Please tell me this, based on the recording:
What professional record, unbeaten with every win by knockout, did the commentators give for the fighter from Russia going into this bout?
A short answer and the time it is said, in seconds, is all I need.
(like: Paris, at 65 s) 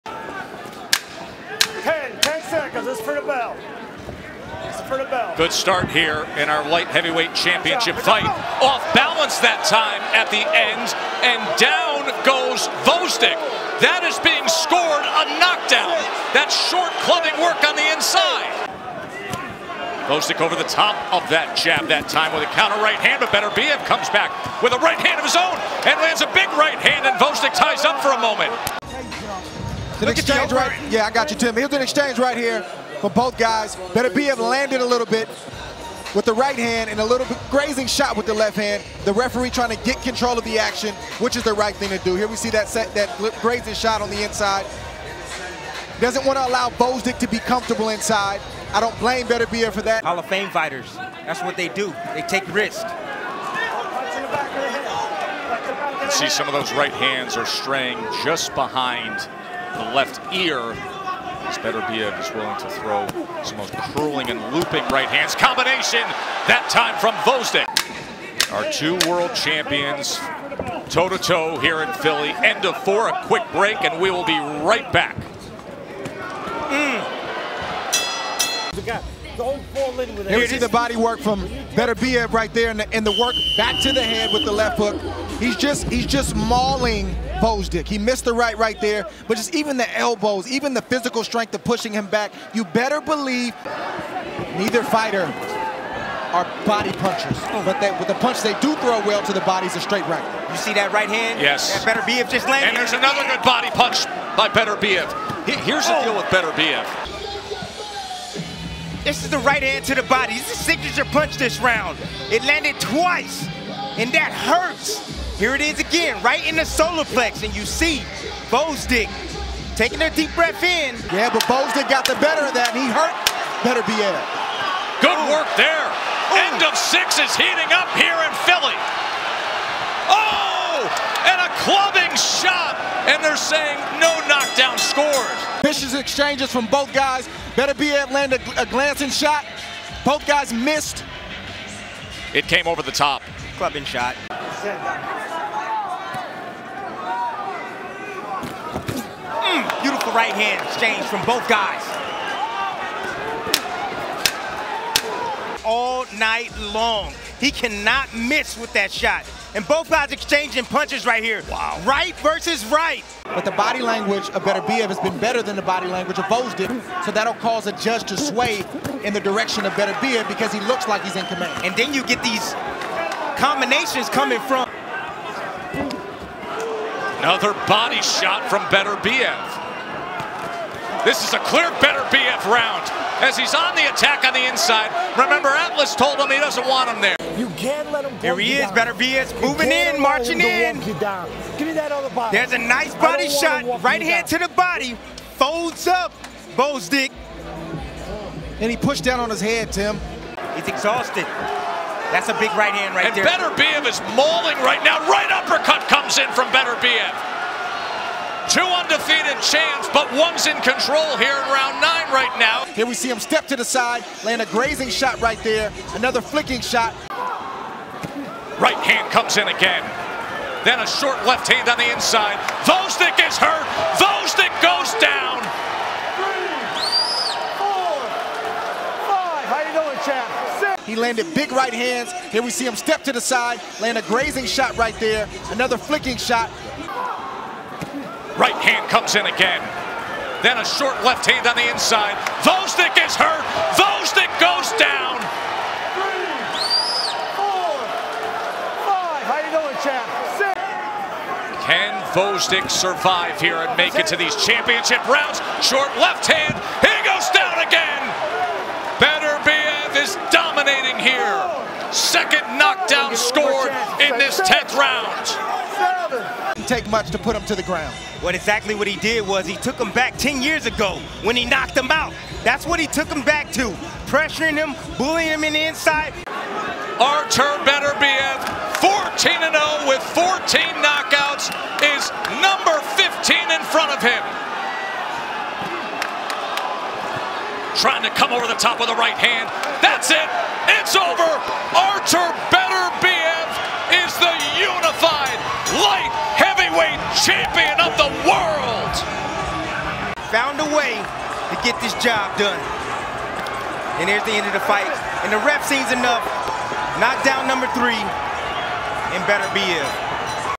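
14-0, at 278 s.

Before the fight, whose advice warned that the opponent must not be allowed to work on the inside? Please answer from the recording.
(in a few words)
Atlas.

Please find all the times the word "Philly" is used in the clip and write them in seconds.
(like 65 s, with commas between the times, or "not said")
71 s, 128 s.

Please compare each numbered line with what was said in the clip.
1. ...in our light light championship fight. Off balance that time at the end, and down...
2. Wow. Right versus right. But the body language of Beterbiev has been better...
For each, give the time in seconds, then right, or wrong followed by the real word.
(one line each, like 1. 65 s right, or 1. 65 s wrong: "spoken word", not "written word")
1. 6 s wrong: "heavyweight", not "light"
2. 161 s right.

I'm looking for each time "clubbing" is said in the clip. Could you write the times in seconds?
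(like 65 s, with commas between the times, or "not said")
17 s, 131 s, 143 s.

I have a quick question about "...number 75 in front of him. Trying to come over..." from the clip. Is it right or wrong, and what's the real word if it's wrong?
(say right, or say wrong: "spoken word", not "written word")
wrong: "15", not "75".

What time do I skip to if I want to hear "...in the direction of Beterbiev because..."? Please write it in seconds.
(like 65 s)
169 s.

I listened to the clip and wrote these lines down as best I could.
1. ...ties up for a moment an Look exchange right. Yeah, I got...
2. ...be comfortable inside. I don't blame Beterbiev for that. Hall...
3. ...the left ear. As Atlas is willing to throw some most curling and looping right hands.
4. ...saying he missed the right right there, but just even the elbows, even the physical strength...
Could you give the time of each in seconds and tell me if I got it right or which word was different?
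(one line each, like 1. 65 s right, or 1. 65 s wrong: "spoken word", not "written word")
1. 27 s right
2. 47 s right
3. 59 s wrong: "Beterbiev", not "Atlas"
4. 86 s wrong: "mauling", not "saying".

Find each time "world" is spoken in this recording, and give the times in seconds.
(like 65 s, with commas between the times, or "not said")
69 s, 298 s.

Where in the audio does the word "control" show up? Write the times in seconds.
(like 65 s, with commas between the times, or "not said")
40 s, 210 s.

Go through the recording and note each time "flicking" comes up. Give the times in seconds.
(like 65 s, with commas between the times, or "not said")
216 s, 235 s.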